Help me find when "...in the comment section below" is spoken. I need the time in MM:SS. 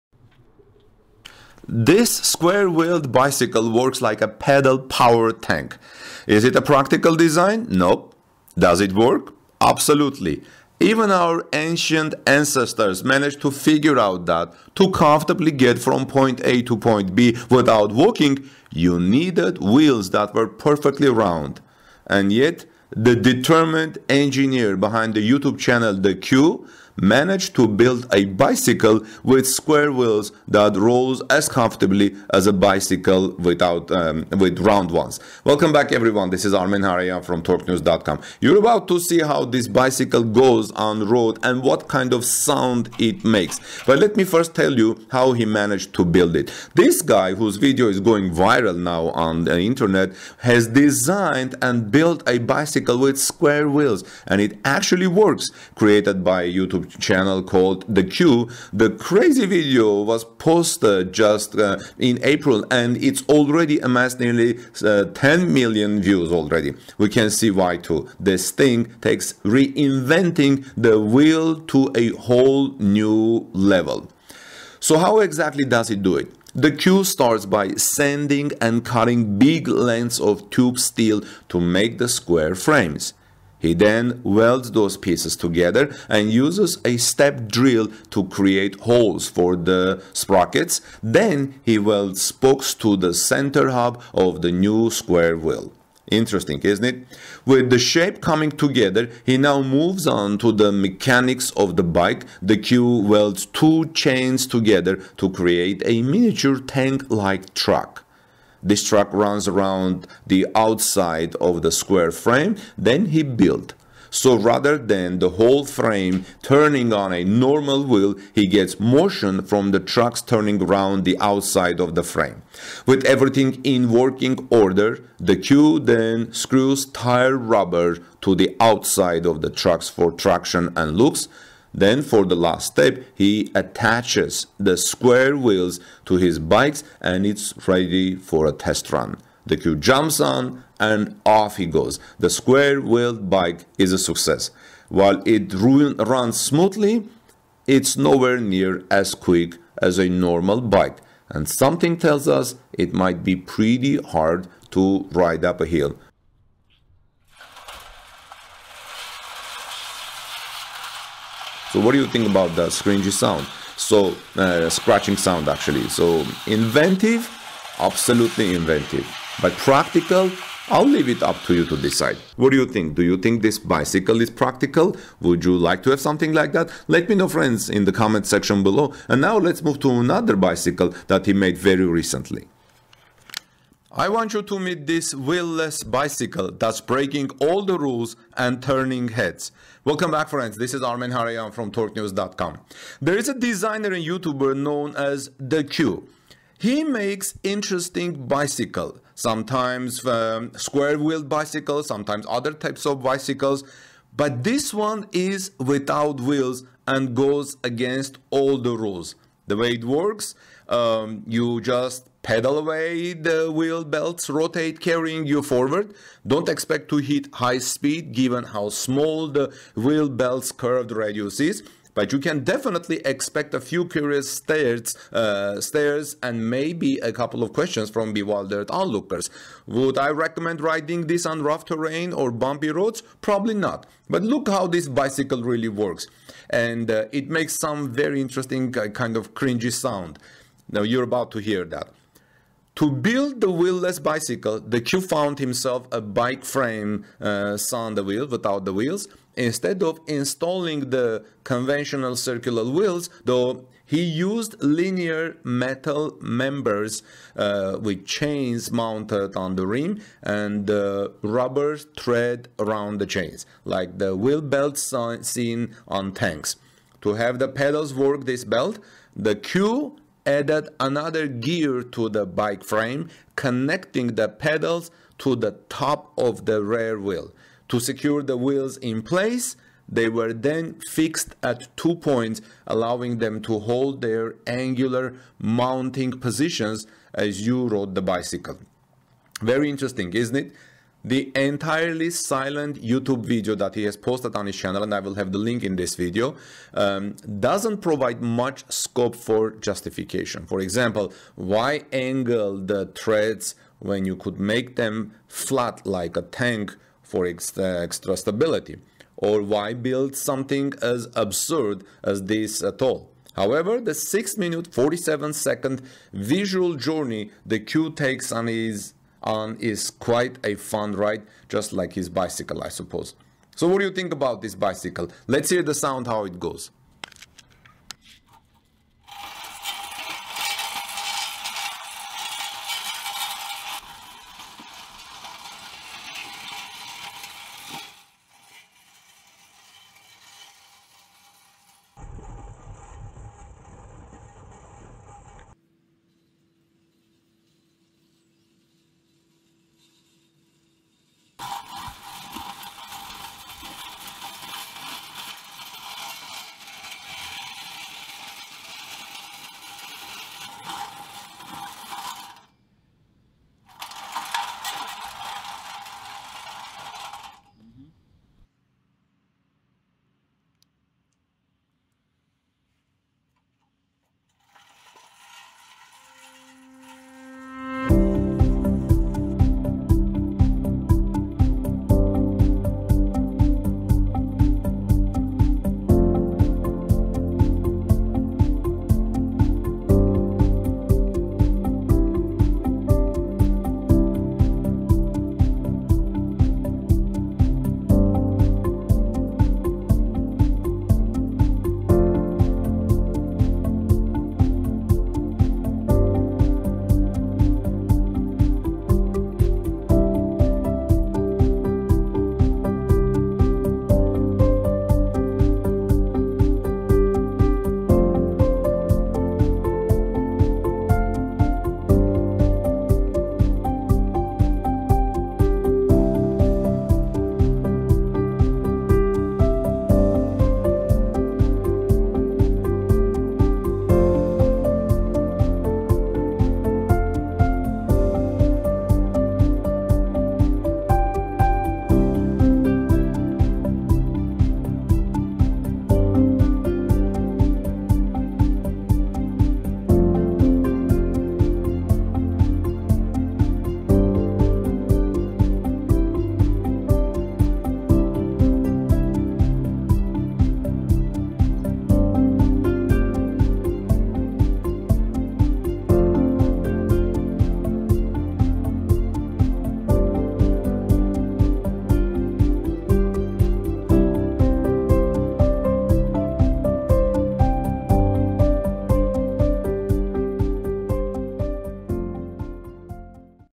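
02:57.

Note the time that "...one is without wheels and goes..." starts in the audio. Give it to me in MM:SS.
03:24.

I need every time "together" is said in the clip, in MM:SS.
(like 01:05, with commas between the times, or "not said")
01:25, 01:38, 01:44.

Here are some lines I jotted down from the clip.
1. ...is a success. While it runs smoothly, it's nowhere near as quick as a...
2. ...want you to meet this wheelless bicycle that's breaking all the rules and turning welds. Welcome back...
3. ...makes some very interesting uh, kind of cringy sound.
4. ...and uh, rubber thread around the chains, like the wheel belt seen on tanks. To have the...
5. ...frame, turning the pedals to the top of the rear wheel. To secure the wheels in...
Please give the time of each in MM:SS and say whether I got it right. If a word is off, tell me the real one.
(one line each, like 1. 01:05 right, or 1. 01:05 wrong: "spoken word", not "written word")
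1. 02:23 right
2. 03:04 wrong: "heads", not "welds"
3. 03:57 right
4. 04:20 right
5. 04:32 wrong: "connecting", not "turning".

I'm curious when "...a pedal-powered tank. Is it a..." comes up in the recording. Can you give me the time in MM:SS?
00:04.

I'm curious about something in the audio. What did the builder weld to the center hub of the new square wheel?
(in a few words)
spokes.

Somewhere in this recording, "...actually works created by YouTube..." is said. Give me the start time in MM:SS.
00:54.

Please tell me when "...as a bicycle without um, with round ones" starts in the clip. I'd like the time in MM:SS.
00:32.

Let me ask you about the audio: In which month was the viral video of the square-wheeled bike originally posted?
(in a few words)
April.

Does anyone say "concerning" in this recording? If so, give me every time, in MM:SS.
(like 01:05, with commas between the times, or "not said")
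not said.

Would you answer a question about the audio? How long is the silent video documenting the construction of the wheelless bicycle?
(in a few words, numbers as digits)
6 minutes 47 seconds.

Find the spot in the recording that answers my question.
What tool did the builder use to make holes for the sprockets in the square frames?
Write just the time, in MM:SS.
01:26.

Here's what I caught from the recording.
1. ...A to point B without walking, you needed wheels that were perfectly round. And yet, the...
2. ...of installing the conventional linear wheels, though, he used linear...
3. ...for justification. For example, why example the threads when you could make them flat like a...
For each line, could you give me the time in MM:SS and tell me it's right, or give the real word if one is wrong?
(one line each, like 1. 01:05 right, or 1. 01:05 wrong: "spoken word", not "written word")
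1. 00:16 right
2. 04:09 wrong: "circular", not "linear"
3. 04:59 wrong: "angle", not "example".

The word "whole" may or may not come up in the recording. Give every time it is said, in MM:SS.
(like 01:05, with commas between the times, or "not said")
01:12, 01:55.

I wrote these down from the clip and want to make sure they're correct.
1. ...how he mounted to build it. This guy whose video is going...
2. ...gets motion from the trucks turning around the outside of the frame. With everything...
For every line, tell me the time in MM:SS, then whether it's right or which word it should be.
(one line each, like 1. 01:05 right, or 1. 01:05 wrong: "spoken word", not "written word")
1. 00:45 wrong: "managed", not "mounted"
2. 01:58 right.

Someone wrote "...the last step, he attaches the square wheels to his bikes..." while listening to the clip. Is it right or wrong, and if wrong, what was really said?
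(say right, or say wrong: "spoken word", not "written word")
right.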